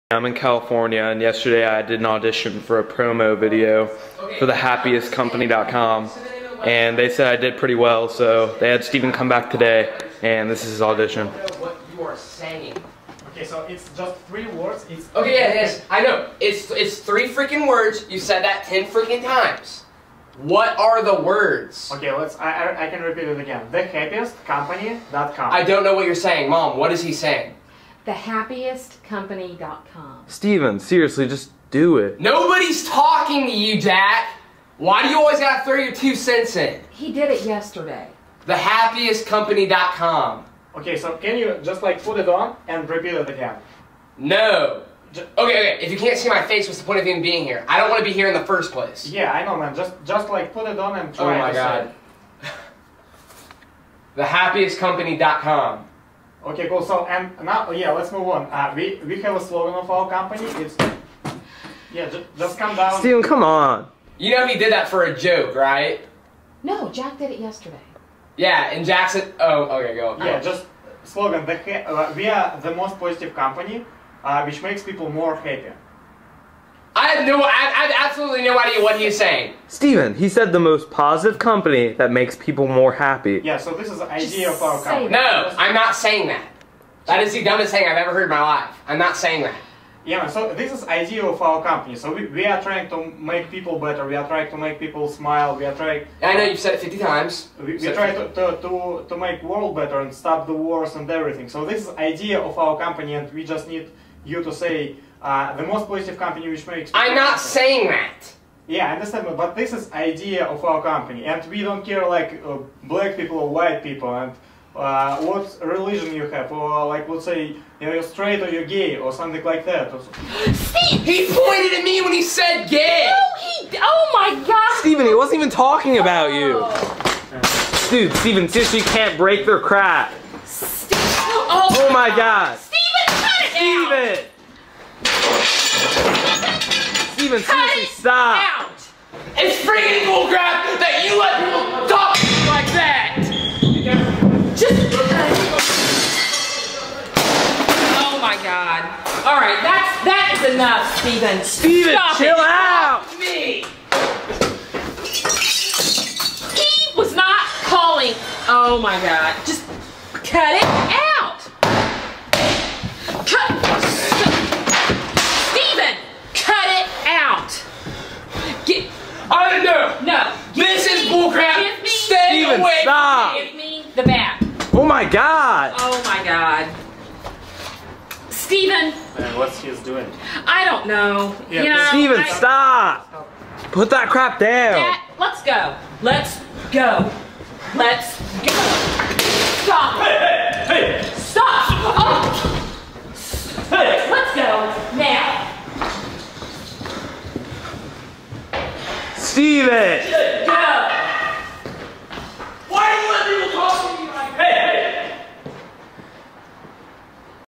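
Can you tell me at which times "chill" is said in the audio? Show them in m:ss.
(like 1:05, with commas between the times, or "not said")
2:32.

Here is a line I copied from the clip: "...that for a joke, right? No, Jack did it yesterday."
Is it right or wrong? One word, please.
right.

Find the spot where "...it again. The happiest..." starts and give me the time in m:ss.
0:23.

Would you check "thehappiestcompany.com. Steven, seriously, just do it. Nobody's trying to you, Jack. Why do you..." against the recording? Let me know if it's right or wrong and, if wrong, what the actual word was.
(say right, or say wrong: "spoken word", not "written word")
wrong: "talking", not "trying".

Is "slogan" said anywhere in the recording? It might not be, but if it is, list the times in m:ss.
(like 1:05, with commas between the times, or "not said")
0:59, 1:11.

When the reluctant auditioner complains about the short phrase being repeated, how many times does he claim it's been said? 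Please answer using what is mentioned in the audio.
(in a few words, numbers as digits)
10.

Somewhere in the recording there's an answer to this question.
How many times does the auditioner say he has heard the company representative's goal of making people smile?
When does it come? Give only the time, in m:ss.
1:36.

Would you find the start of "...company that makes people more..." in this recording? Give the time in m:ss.
1:21.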